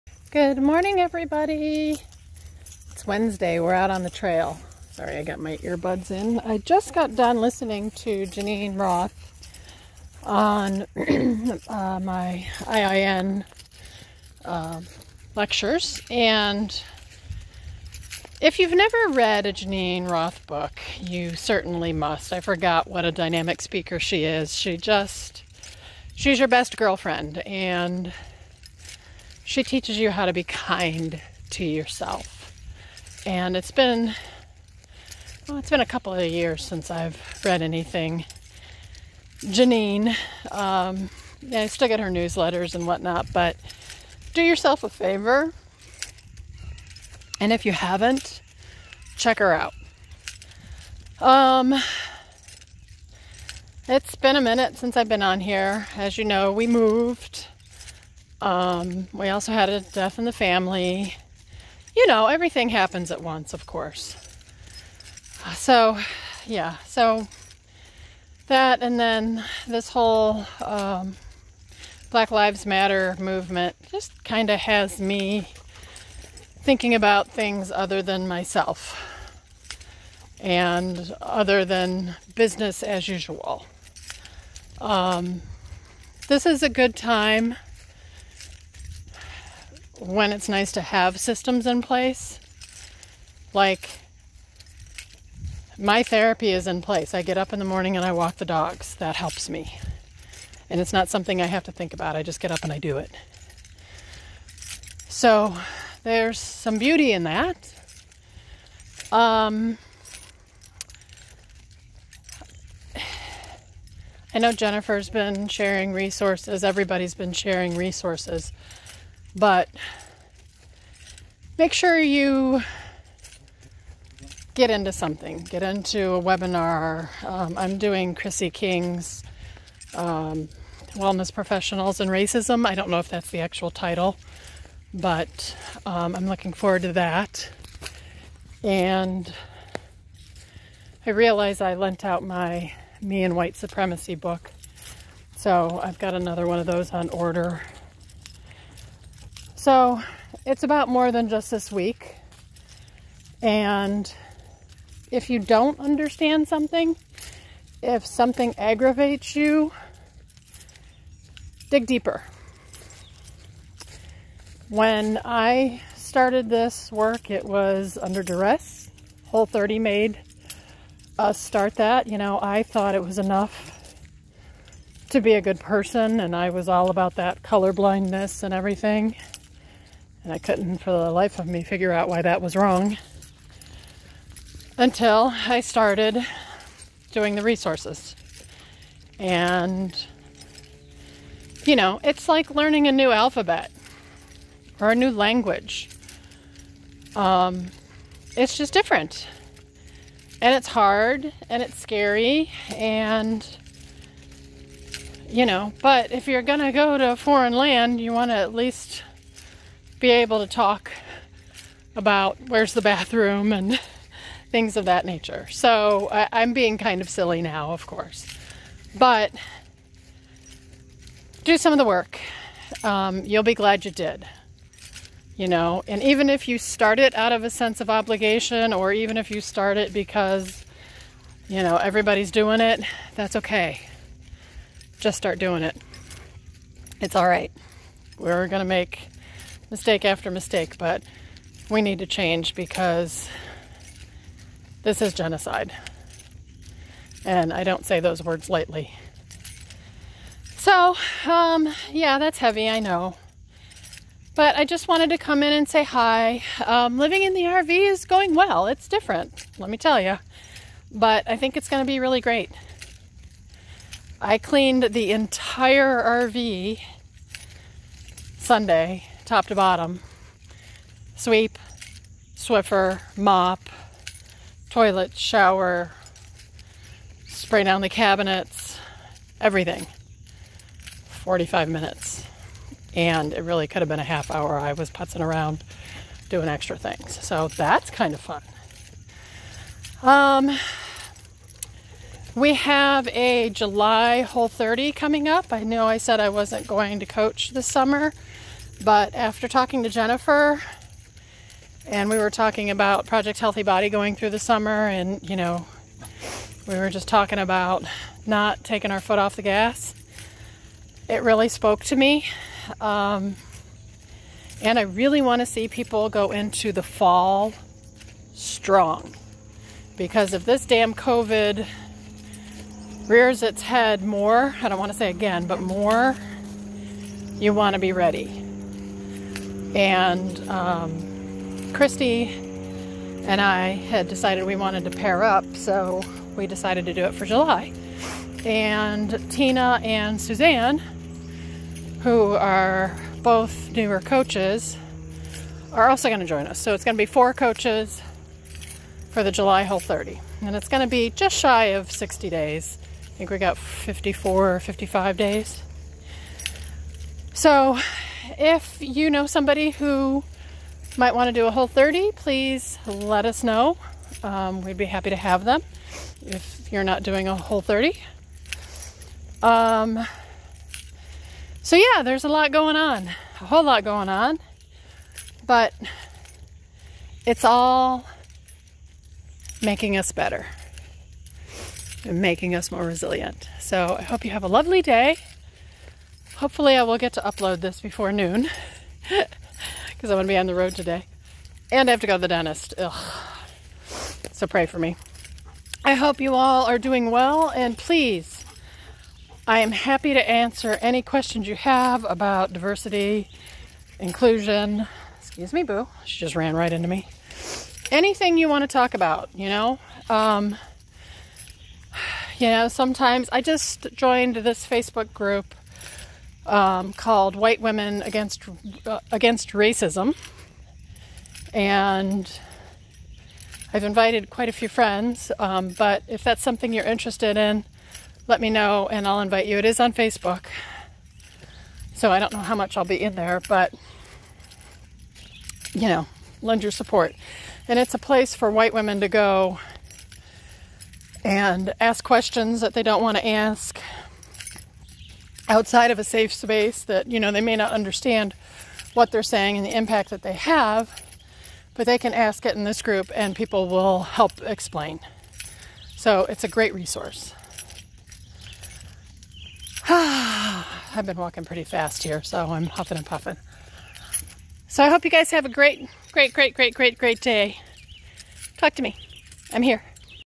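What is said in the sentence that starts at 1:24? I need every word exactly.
Um, this is a good time when it's nice to have systems in place.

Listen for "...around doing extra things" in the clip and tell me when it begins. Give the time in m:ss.
4:45.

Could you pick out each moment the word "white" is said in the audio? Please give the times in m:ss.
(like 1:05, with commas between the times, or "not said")
2:23, 6:57, 7:18.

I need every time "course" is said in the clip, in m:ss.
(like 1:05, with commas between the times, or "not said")
1:03, 3:37.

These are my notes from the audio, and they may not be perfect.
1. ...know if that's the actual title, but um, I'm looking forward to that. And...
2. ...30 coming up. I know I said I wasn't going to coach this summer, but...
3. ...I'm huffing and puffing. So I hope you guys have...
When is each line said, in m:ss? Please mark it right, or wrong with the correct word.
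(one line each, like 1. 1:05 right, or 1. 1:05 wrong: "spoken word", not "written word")
1. 2:12 right
2. 4:54 right
3. 7:42 right.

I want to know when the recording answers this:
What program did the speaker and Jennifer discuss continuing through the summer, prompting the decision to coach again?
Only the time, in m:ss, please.
5:03.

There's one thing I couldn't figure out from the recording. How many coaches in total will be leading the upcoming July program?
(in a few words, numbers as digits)
4.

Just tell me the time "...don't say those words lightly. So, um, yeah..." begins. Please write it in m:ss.
4:07.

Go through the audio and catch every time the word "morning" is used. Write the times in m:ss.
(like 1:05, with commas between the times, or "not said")
0:00, 1:37.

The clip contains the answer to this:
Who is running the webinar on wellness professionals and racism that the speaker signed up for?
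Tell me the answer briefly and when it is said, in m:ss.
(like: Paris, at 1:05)
Chrissy King, at 2:08.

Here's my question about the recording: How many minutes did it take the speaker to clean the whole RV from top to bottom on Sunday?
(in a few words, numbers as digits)
45 minutes.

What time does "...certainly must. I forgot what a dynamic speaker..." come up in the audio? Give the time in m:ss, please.
0:21.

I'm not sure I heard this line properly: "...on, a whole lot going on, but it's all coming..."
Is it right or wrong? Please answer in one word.
wrong.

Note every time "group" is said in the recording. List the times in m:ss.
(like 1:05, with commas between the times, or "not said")
6:55, 7:32.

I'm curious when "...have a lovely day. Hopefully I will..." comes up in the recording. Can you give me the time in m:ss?
6:24.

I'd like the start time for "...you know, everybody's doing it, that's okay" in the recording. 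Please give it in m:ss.
3:51.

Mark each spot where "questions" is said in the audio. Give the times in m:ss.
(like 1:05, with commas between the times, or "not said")
6:41, 7:22.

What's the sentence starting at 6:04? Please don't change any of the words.
Um, we'd be happy to have them if you're not doing a whole 30.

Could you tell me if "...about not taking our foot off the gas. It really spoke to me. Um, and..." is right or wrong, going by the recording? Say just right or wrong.
right.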